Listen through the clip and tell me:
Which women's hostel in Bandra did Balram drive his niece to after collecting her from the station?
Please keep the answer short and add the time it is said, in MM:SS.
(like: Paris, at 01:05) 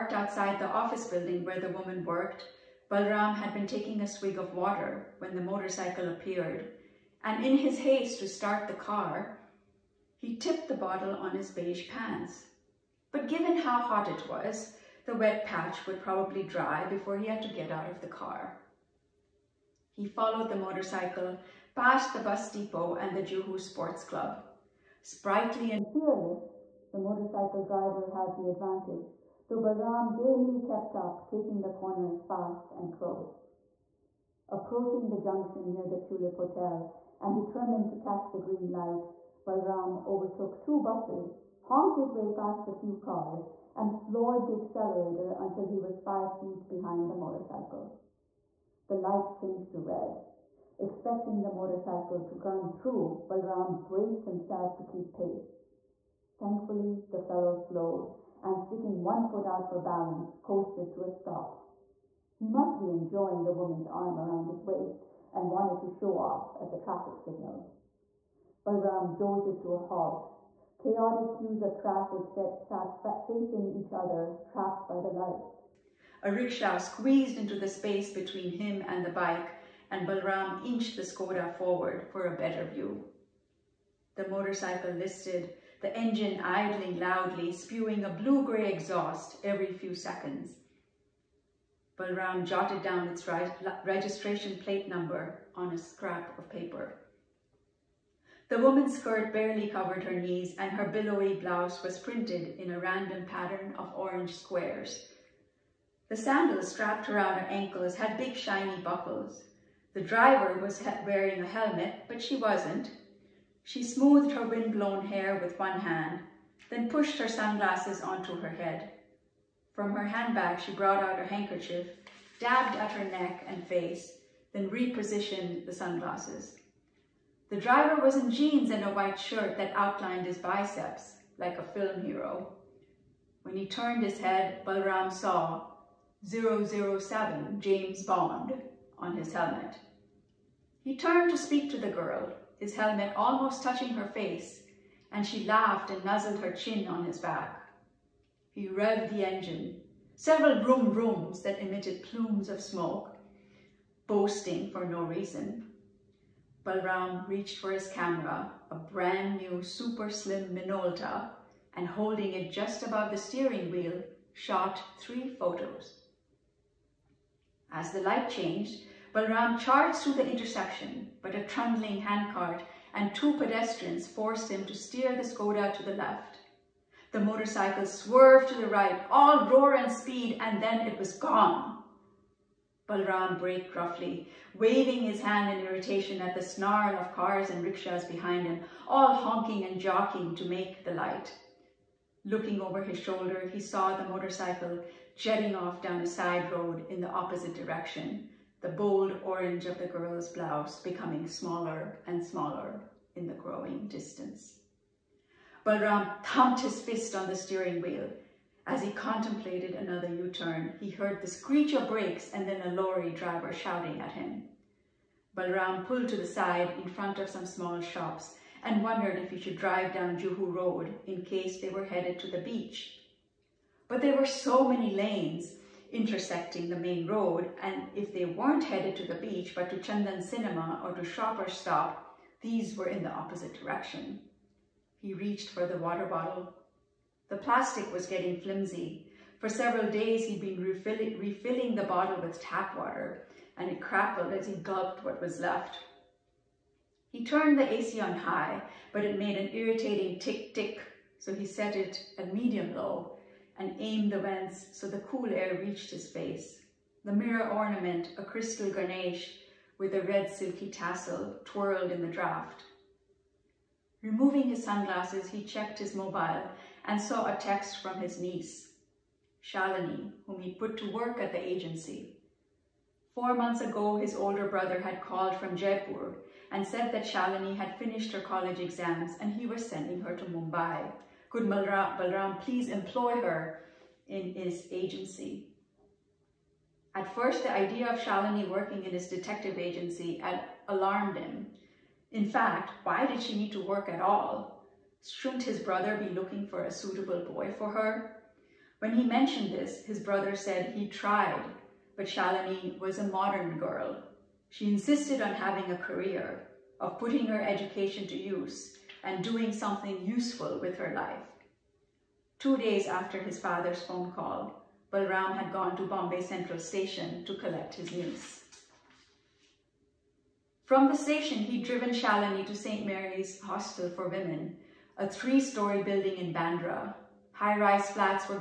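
St. Mary's Hostel for Women, at 05:22.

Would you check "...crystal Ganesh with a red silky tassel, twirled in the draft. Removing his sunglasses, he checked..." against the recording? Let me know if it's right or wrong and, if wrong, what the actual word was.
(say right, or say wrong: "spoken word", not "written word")
right.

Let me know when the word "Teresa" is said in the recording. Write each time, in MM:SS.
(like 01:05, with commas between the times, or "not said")
not said.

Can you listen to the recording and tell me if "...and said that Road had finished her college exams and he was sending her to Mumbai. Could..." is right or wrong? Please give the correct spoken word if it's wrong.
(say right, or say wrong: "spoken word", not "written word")
wrong: "Shalini", not "Road".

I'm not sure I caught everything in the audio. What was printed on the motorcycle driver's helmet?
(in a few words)
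007 James Bond.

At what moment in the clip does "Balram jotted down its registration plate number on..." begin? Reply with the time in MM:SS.
01:31.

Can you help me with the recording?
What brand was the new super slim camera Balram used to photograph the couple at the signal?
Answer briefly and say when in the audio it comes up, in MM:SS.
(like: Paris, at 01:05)
Minolta, at 02:40.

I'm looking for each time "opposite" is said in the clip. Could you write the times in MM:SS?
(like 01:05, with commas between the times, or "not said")
03:17, 03:53.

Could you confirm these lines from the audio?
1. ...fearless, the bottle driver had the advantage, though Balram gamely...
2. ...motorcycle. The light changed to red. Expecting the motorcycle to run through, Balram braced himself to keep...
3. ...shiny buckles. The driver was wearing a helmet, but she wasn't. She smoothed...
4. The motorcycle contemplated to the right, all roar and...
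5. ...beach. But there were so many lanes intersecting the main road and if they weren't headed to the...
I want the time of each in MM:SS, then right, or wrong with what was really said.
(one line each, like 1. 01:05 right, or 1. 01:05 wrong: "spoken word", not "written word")
1. 00:25 wrong: "motorcycle", not "bottle"
2. 00:47 right
3. 01:48 right
4. 02:57 wrong: "swerved", not "contemplated"
5. 03:42 right.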